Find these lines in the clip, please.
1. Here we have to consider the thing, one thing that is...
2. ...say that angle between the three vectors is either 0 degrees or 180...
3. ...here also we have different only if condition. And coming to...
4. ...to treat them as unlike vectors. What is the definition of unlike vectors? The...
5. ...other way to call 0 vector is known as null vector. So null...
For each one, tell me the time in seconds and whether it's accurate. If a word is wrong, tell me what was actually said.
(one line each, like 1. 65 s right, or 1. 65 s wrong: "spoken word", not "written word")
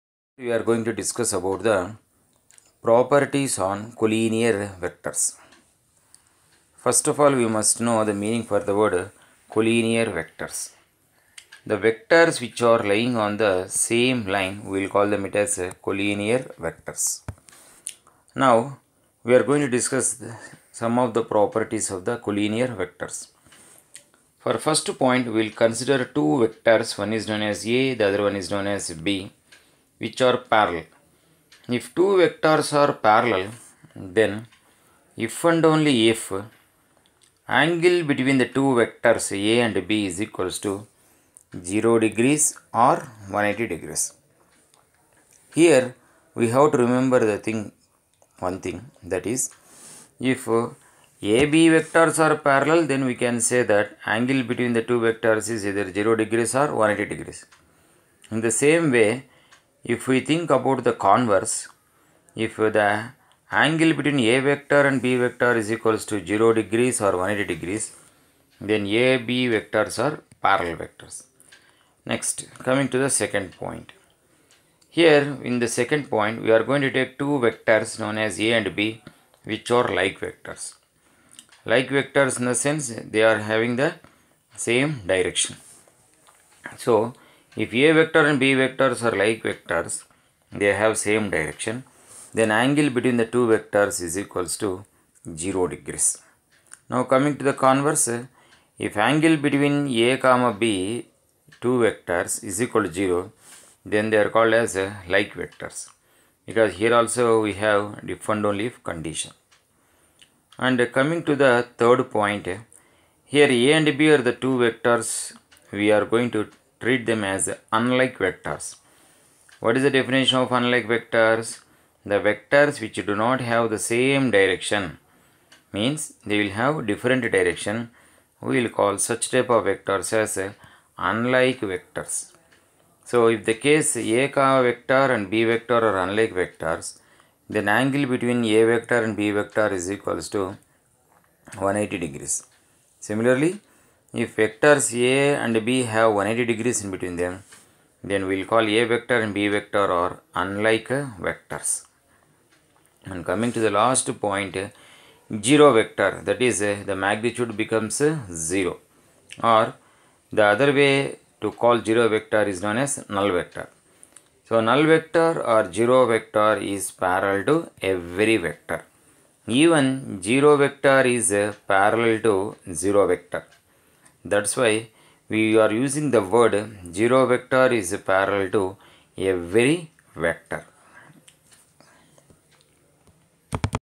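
1. 45 s wrong: "remember", not "consider"
2. 53 s wrong: "two", not "three"
3. 106 s right
4. 116 s right
5. 160 s right.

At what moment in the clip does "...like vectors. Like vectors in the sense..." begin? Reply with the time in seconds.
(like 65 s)
79 s.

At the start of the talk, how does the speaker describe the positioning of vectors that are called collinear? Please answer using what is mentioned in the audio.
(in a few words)
lying on the same line.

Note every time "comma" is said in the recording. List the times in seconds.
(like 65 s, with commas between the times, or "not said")
100 s.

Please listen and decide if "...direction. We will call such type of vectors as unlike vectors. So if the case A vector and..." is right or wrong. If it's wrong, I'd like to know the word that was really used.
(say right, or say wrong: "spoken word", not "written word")
right.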